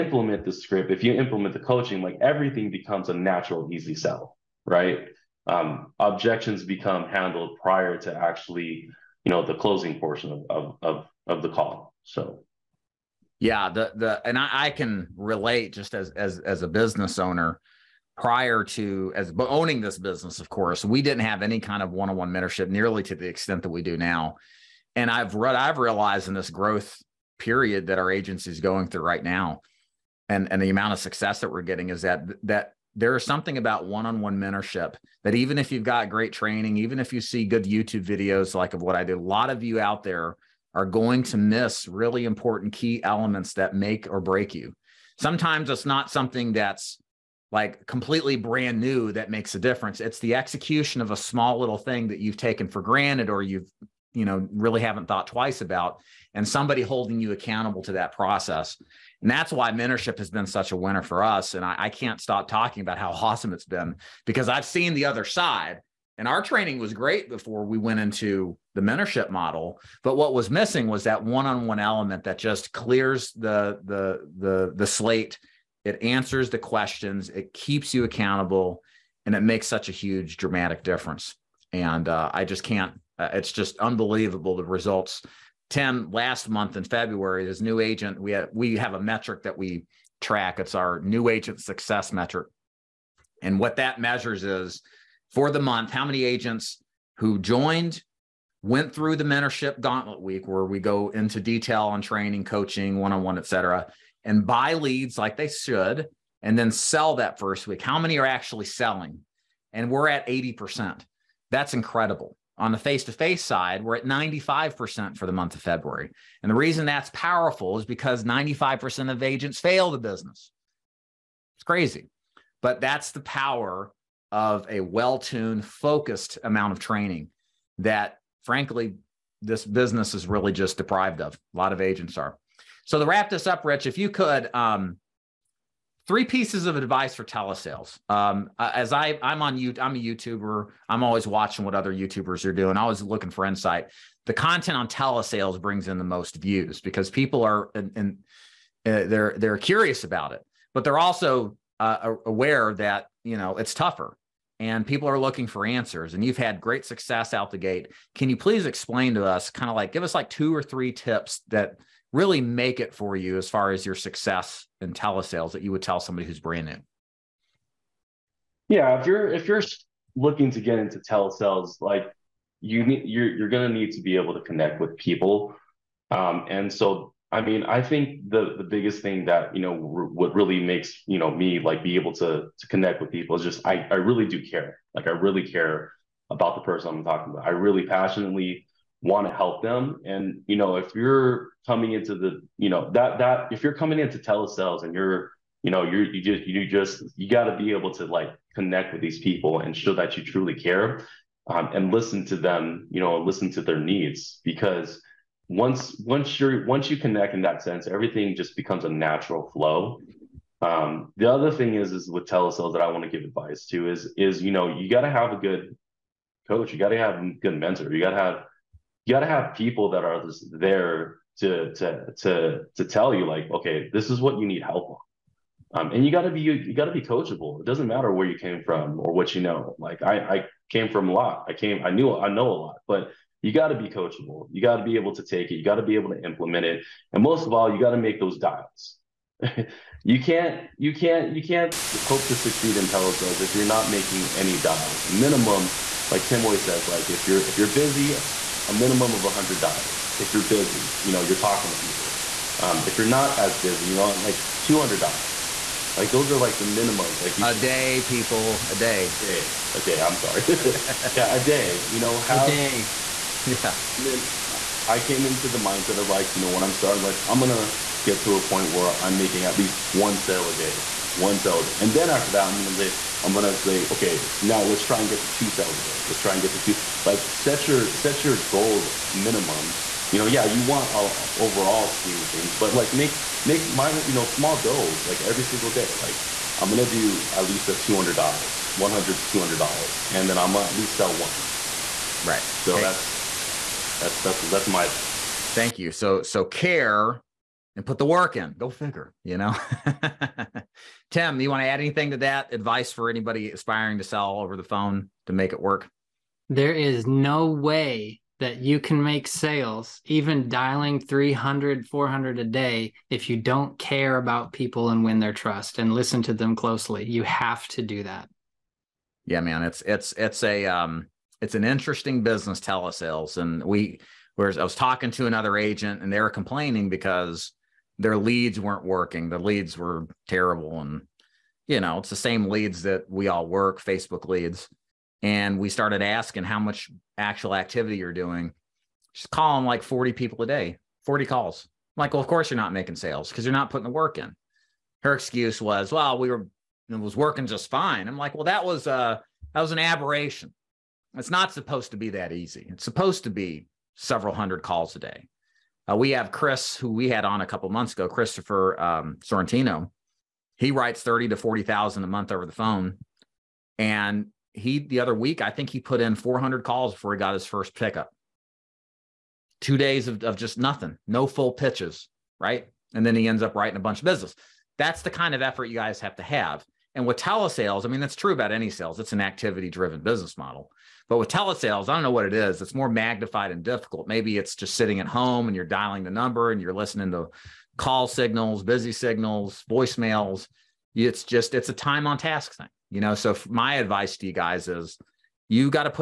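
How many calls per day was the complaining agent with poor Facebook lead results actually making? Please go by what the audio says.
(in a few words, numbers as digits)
40.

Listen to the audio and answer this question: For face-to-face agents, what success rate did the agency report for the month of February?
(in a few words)
95% for the month of February.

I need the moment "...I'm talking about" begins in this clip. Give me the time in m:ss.
3:06.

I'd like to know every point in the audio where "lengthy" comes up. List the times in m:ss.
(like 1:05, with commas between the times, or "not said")
not said.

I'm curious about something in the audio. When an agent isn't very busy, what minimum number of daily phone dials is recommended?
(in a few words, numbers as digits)
200 dials.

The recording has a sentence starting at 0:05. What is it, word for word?
Um, objections become handled prior to actually you know the closing portion of of, of, of the call.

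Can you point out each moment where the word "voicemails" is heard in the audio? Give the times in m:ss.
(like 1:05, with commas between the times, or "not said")
6:29.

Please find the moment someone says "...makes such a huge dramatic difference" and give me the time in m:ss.
1:19.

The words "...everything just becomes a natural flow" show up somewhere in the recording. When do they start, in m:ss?
3:27.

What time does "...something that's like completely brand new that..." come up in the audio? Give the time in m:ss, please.
0:46.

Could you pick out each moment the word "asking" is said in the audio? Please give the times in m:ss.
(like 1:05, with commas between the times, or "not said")
5:36.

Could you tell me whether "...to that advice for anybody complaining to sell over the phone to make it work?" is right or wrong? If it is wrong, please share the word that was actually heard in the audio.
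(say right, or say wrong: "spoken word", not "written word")
wrong: "aspiring", not "complaining".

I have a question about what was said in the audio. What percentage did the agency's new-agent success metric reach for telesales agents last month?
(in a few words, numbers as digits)
80%.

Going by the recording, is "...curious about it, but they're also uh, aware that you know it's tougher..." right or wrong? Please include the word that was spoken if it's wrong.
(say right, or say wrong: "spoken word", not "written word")
right.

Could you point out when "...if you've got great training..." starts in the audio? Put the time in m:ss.
0:35.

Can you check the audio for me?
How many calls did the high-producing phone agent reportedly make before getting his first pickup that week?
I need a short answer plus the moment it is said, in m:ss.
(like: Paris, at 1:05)
400, at 6:06.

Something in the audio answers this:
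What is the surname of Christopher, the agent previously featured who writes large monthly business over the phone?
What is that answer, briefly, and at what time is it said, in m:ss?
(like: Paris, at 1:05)
Sorrentino, at 5:59.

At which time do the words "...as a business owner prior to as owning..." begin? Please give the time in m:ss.
0:16.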